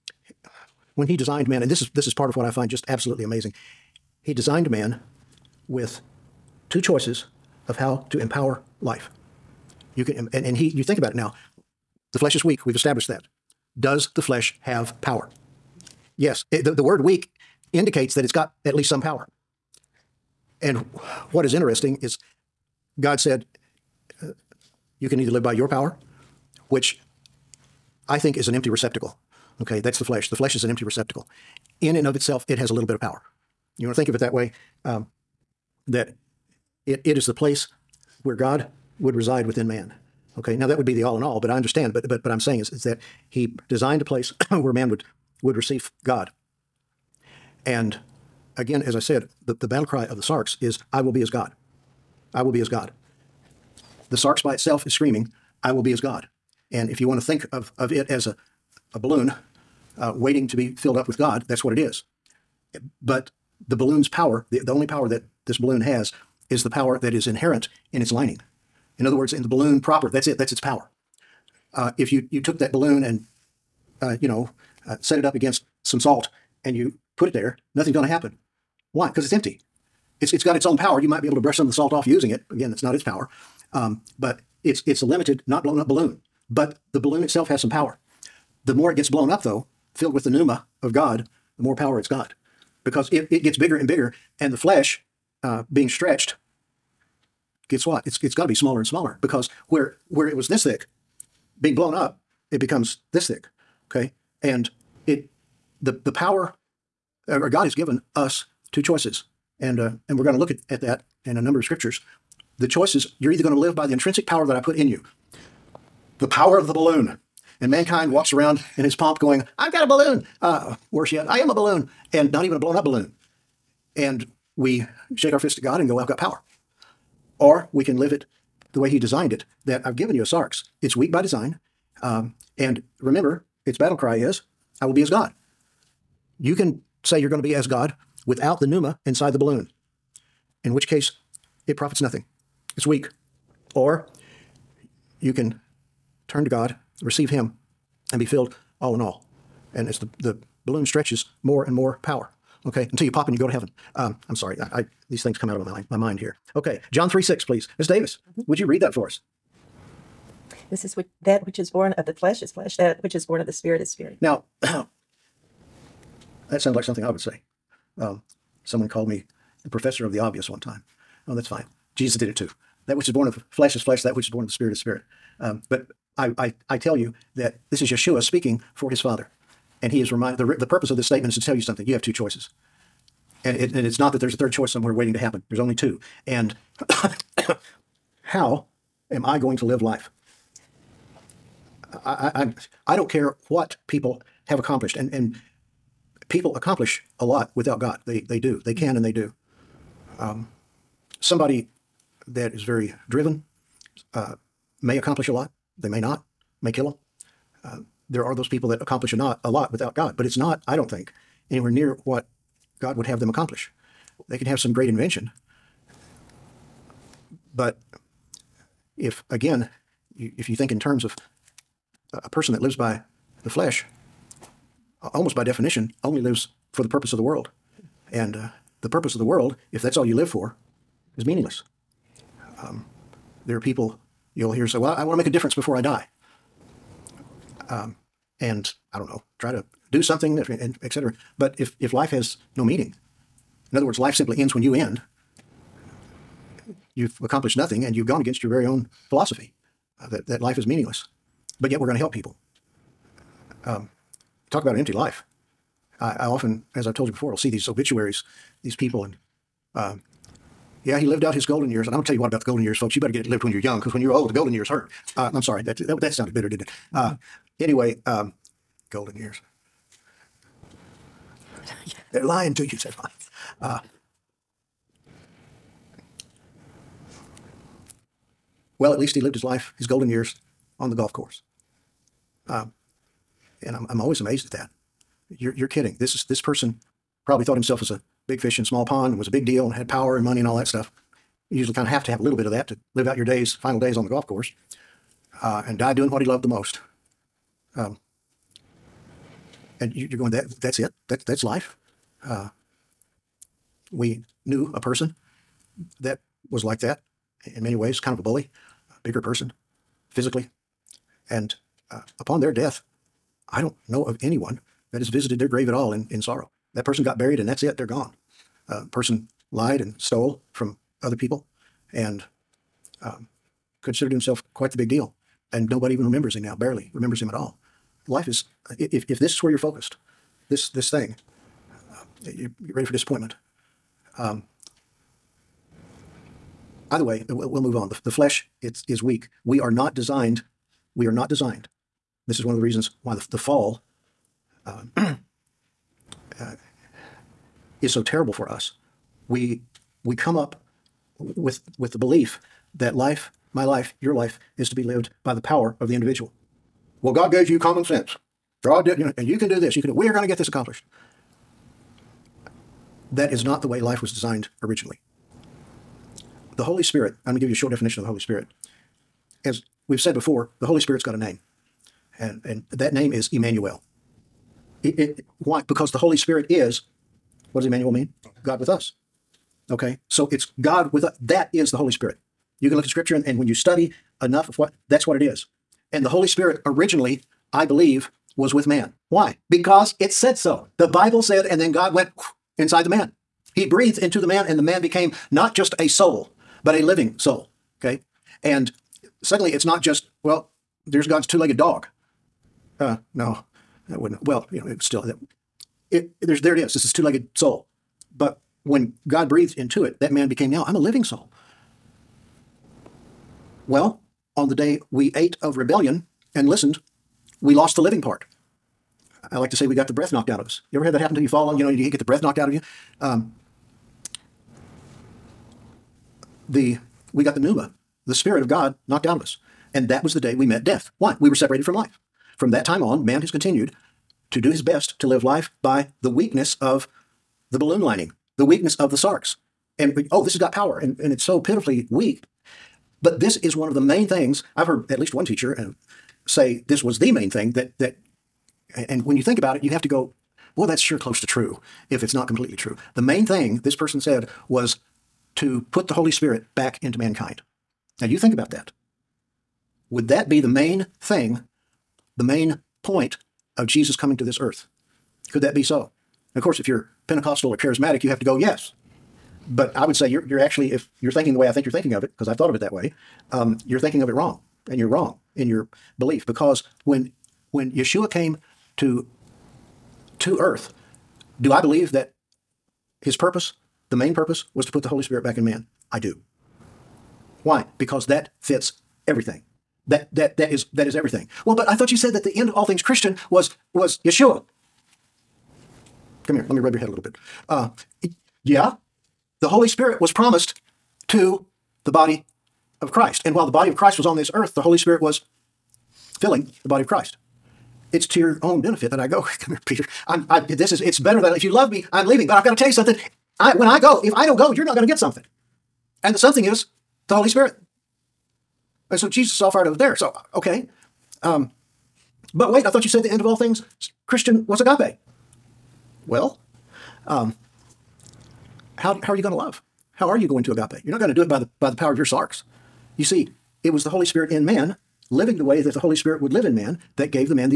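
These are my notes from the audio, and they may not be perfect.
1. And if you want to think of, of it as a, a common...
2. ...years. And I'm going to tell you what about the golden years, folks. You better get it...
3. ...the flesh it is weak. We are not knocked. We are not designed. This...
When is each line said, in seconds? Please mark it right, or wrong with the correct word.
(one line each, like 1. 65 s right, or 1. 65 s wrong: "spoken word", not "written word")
1. 56 s wrong: "balloon", not "common"
2. 261 s right
3. 338 s wrong: "designed", not "knocked".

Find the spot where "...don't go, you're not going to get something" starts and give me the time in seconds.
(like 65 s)
514 s.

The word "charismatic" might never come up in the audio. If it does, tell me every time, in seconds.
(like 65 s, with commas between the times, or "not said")
467 s.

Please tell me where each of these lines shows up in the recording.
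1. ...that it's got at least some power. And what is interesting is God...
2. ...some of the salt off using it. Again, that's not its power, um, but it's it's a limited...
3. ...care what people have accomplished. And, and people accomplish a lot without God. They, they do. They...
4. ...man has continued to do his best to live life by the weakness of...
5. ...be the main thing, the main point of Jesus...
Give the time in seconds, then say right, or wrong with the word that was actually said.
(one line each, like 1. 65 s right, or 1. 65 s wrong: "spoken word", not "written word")
1. 18 s right
2. 81 s right
3. 193 s right
4. 433 s right
5. 460 s right.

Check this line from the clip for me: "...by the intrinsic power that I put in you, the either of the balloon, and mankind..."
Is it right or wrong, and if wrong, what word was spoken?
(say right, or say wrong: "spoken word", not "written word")
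wrong: "power", not "either".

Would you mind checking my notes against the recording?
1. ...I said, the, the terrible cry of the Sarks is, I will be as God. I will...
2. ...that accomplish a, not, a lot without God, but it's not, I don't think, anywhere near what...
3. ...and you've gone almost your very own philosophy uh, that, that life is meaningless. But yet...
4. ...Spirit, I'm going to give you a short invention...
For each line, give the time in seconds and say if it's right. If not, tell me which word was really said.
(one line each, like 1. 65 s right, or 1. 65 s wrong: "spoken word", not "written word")
1. 48 s wrong: "battle", not "terrible"
2. 208 s right
3. 247 s wrong: "against", not "almost"
4. 366 s wrong: "definition", not "invention".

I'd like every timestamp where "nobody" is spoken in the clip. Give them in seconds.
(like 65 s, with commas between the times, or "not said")
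325 s.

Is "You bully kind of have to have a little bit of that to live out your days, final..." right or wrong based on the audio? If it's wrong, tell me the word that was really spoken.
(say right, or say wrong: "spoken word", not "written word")
wrong: "usually", not "bully".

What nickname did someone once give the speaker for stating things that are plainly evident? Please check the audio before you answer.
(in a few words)
Professor of the obvious.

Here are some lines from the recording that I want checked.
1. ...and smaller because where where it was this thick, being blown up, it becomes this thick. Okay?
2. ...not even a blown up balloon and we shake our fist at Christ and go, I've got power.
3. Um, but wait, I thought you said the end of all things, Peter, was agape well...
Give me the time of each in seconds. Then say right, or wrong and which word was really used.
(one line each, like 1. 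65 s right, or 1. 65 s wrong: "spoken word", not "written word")
1. 98 s right
2. 122 s wrong: "God", not "Christ"
3. 521 s wrong: "Christian", not "Peter".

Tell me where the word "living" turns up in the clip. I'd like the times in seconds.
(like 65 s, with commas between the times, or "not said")
396 s, 410 s, 417 s, 535 s.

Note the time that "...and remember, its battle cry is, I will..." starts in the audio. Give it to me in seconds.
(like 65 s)
132 s.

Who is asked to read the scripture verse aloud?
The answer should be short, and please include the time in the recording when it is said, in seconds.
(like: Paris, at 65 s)
Ms. Davis, at 157 s.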